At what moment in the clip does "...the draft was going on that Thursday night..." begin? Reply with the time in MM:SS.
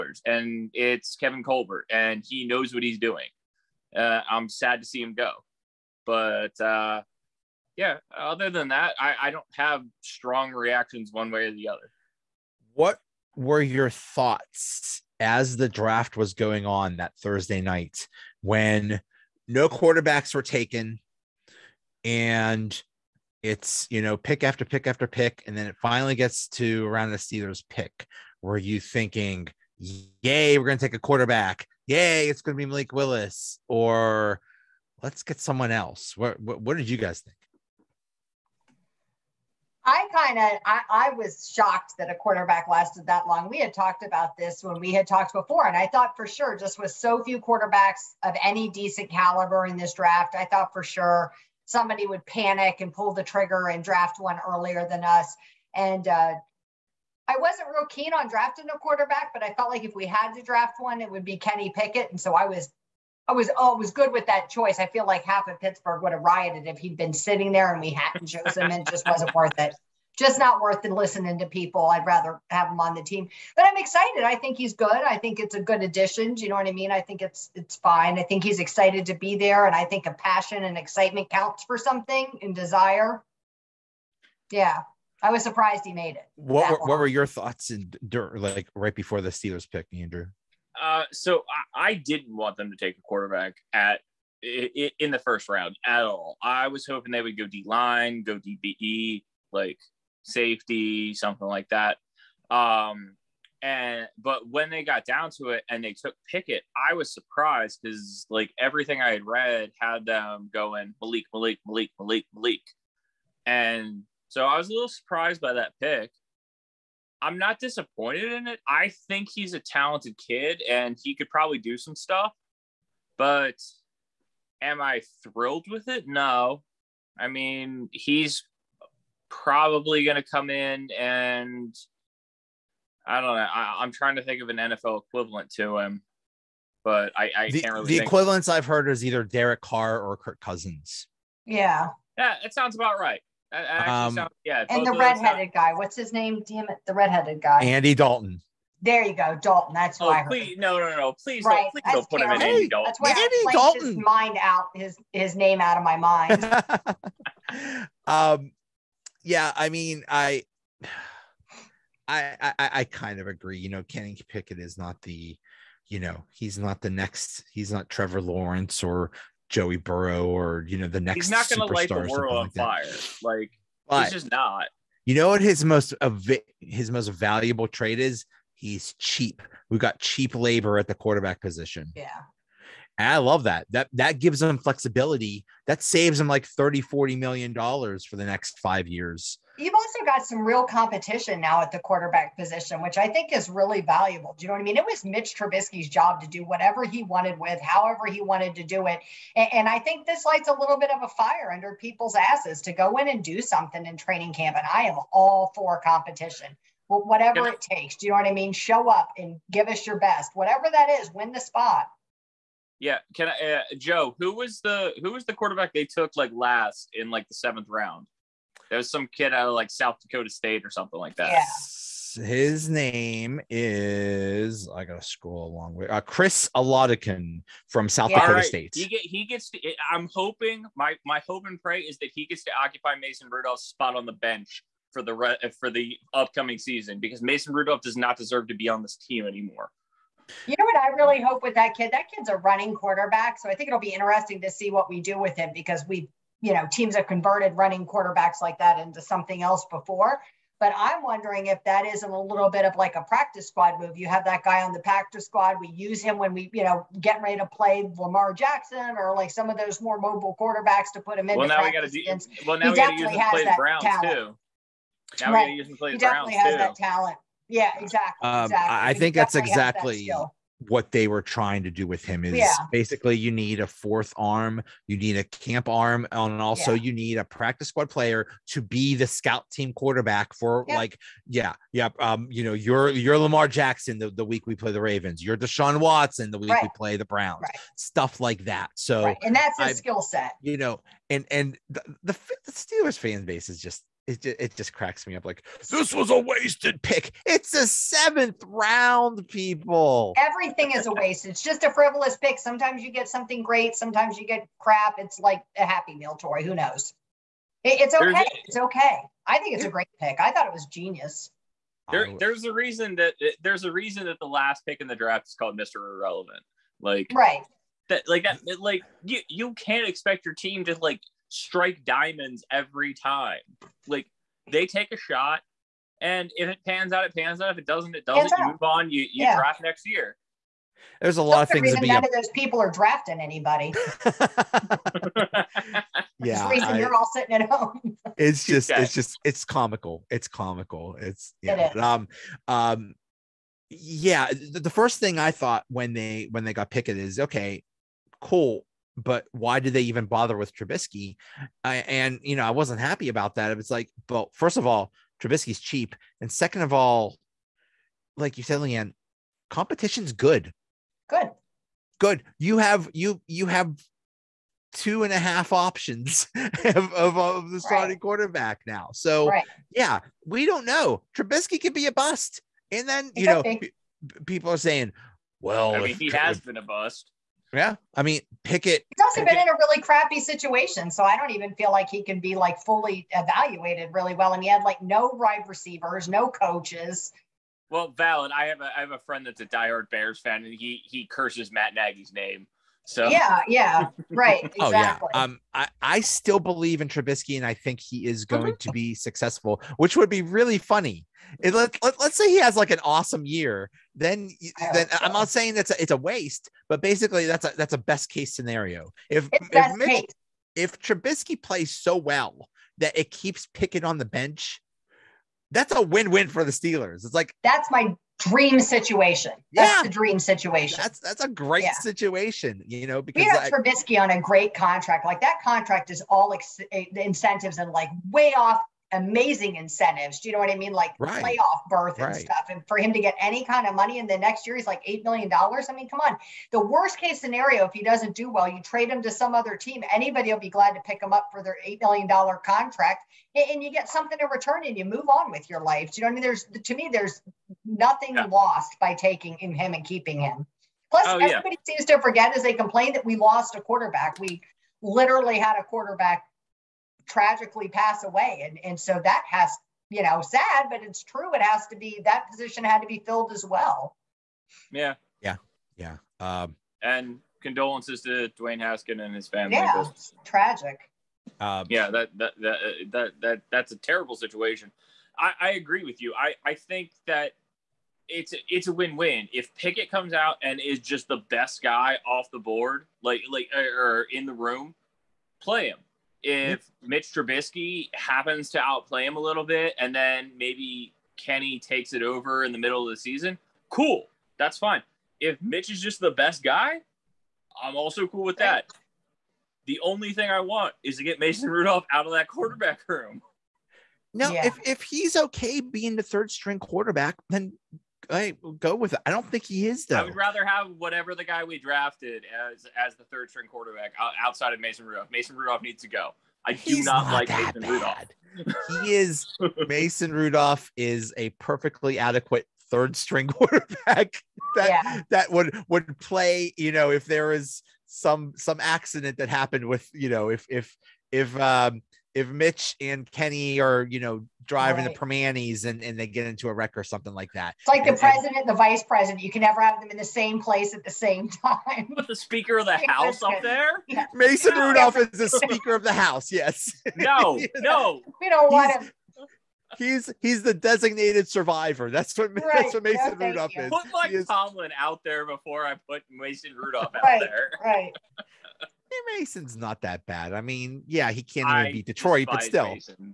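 00:15.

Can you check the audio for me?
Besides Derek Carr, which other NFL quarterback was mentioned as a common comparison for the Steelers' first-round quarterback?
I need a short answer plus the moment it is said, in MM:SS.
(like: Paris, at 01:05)
Kirk Cousins, at 02:20.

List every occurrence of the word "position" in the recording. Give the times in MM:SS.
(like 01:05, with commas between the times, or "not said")
03:01, 03:12, 07:42.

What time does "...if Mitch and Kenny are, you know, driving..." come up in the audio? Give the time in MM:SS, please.
08:52.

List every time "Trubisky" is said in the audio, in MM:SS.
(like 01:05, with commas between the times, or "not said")
03:15, 05:50, 05:55, 06:11, 06:36, 06:50, 07:03, 08:07.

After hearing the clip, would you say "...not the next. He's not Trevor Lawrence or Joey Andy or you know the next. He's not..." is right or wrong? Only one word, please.
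wrong.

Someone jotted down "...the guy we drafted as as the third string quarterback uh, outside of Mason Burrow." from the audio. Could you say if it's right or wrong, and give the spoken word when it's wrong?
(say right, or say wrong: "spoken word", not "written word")
wrong: "Rudolph", not "Burrow".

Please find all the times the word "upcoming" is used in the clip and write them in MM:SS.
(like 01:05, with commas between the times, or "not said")
03:56.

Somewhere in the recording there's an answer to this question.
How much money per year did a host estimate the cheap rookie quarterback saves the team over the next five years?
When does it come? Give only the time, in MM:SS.
03:06.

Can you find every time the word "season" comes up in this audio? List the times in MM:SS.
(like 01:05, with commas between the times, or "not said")
03:56, 08:12.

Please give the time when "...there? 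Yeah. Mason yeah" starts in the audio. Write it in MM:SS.
09:03.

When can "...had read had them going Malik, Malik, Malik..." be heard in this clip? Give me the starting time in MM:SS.
01:49.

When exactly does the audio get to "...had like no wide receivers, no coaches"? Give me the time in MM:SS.
06:24.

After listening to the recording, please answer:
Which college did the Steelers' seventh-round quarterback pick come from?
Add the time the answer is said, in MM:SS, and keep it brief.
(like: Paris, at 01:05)
South Dakota State, at 03:39.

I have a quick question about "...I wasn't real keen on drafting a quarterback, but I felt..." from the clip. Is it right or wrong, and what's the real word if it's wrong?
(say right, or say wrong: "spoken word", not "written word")
right.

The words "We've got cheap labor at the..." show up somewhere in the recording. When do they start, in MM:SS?
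02:59.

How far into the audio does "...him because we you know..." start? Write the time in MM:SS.
04:05.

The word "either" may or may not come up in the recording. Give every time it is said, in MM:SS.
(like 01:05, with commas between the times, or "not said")
02:19.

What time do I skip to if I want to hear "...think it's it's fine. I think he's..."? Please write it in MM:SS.
01:16.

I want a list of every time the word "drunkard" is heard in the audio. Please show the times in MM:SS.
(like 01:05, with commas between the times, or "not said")
not said.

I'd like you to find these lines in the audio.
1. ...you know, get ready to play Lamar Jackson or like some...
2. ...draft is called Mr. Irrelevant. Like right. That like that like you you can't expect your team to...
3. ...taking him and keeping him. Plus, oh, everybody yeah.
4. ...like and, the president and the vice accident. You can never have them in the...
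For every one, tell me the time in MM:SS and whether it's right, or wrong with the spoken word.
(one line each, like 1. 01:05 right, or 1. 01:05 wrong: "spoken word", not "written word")
1. 04:16 right
2. 05:14 right
3. 07:28 right
4. 08:57 wrong: "president", not "accident".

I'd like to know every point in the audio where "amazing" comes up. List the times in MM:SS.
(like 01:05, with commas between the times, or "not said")
07:08.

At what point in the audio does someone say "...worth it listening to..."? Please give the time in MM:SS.
01:10.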